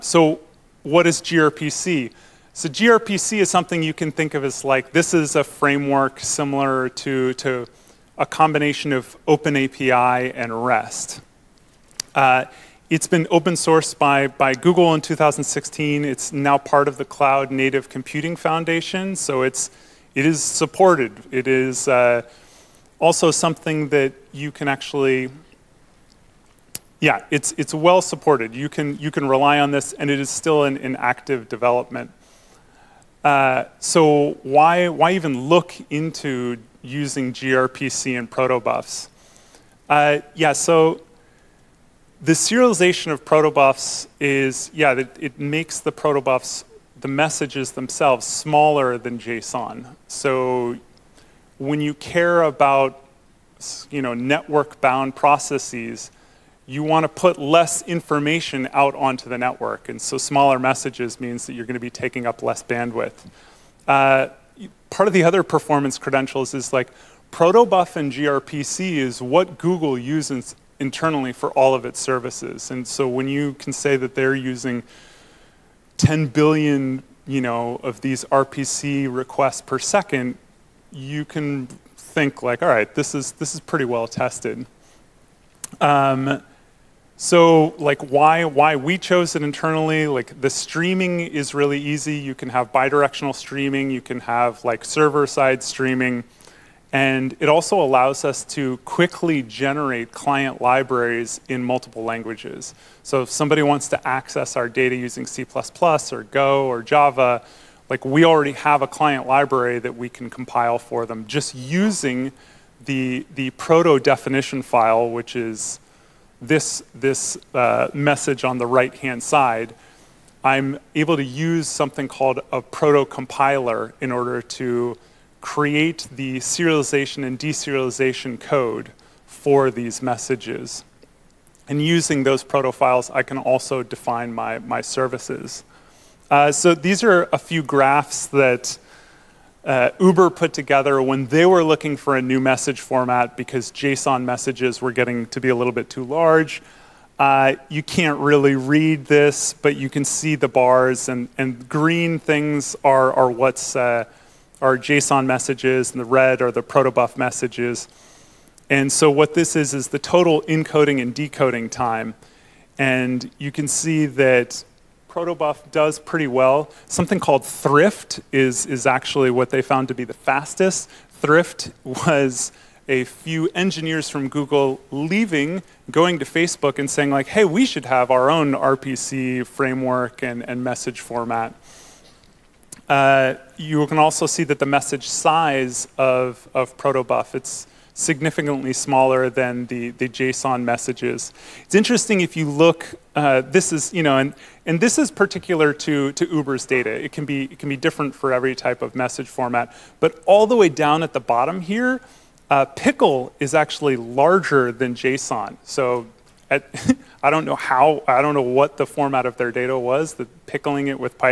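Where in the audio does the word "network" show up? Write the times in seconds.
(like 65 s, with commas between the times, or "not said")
54 s, 59 s.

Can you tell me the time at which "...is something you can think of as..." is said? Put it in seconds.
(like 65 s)
3 s.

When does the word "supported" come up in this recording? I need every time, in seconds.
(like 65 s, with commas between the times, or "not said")
20 s, 28 s.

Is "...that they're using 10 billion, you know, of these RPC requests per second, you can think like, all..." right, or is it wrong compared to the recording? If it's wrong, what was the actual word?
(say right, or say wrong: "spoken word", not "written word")
right.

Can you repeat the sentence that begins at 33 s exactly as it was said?
Uh, so why, why even look into using gRPC and protobufs?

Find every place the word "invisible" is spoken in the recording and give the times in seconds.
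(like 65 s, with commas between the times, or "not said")
not said.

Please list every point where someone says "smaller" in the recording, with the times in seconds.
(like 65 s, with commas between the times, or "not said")
48 s, 60 s, 188 s.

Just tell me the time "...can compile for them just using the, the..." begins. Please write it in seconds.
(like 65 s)
110 s.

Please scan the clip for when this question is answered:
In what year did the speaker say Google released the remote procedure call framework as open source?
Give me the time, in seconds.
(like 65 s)
15 s.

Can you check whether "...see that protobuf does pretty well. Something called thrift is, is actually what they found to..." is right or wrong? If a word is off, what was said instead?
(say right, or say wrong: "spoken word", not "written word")
right.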